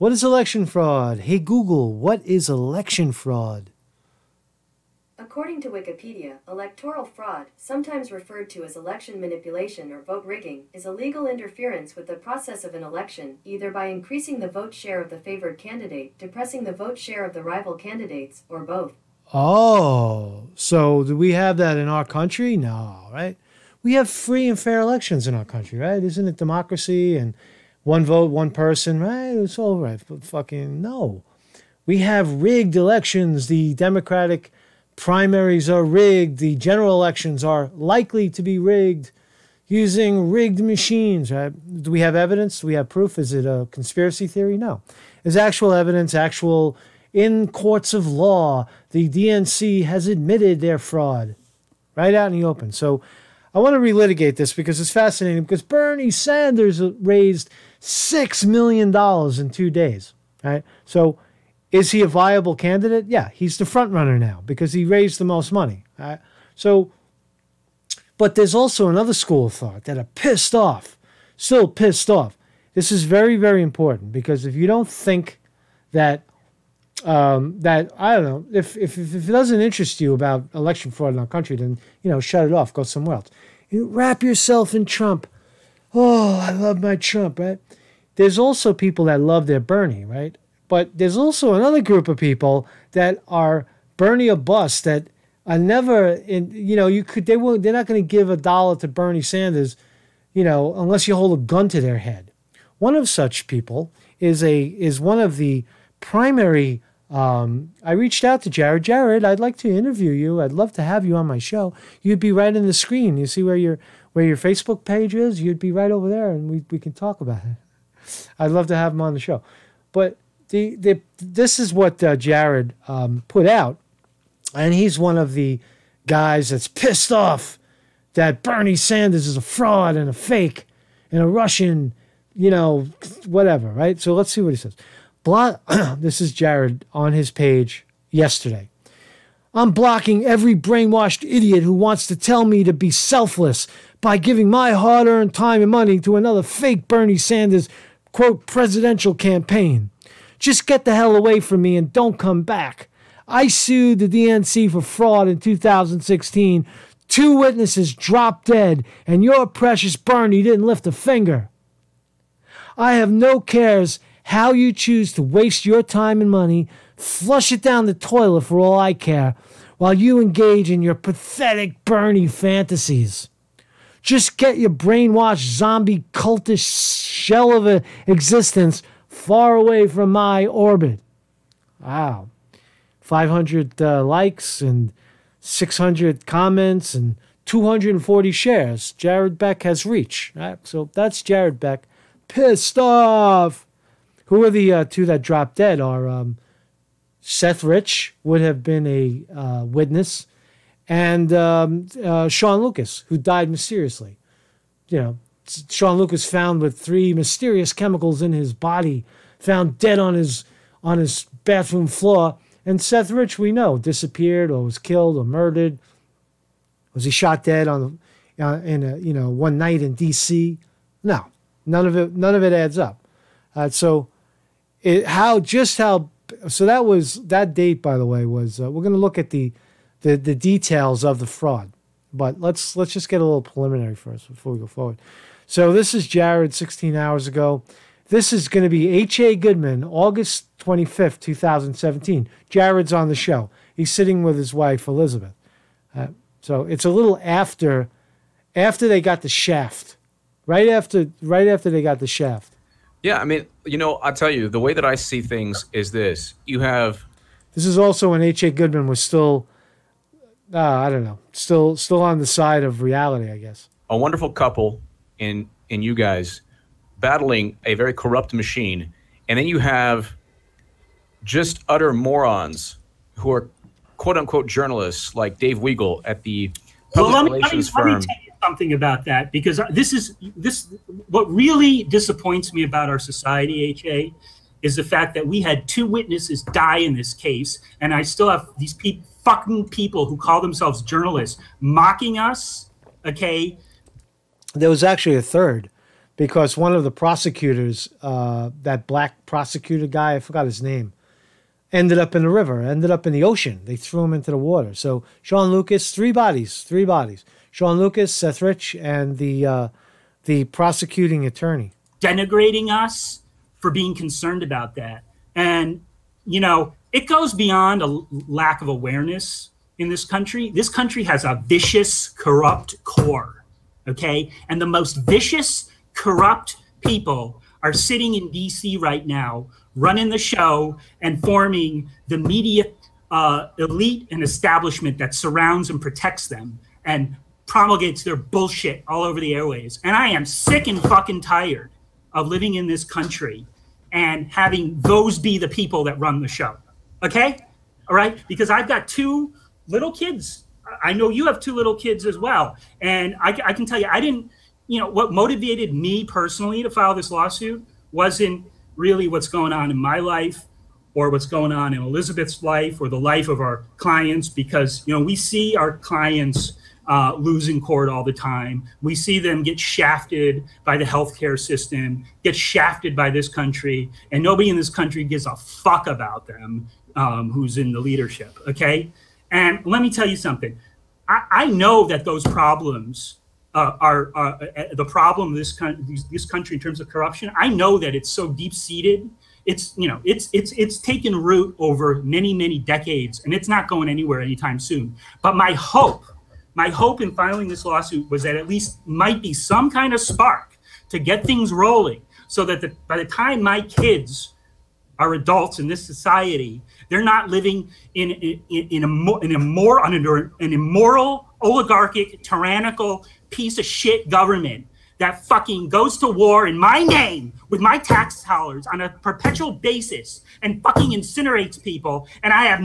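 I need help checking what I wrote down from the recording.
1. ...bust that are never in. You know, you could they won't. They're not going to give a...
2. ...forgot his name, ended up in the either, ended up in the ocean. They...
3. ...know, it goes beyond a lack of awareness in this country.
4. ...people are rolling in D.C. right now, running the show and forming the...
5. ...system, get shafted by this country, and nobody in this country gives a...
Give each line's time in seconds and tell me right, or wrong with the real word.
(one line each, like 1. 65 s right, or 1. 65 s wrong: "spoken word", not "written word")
1. 94 s right
2. 300 s wrong: "river", not "either"
3. 316 s right
4. 326 s wrong: "sitting", not "rolling"
5. 371 s right.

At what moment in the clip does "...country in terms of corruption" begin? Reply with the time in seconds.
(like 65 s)
386 s.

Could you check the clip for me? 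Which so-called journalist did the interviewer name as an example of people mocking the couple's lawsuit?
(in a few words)
Dave Weigel.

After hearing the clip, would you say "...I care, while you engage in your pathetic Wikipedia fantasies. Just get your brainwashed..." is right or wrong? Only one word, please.
wrong.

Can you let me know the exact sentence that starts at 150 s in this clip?
Just get the hell away from me and don't come back.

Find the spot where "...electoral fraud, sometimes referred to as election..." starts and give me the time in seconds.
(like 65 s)
6 s.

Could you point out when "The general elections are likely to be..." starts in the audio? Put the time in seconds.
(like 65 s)
36 s.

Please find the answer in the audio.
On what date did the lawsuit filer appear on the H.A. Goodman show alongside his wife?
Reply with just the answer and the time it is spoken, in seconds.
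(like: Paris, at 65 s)
August 25th 2017, at 239 s.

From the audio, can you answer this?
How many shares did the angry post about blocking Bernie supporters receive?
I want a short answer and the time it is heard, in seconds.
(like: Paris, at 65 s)
240, at 187 s.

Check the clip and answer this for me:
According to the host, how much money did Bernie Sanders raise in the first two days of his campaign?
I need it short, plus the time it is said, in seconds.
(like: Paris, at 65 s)
$6 million, at 57 s.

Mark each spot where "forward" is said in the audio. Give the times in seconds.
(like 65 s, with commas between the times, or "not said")
234 s.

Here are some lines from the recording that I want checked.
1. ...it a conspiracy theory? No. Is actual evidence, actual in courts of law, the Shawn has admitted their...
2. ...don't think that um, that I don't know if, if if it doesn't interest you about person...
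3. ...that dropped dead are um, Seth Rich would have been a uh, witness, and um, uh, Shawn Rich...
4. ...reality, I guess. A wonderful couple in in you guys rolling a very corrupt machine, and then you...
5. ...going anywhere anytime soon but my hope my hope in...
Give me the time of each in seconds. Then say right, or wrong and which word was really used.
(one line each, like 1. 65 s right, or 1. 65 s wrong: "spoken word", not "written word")
1. 43 s wrong: "DNC", not "Shawn"
2. 74 s wrong: "election", not "person"
3. 195 s wrong: "Lucas", not "Rich"
4. 262 s wrong: "battling", not "rolling"
5. 393 s right.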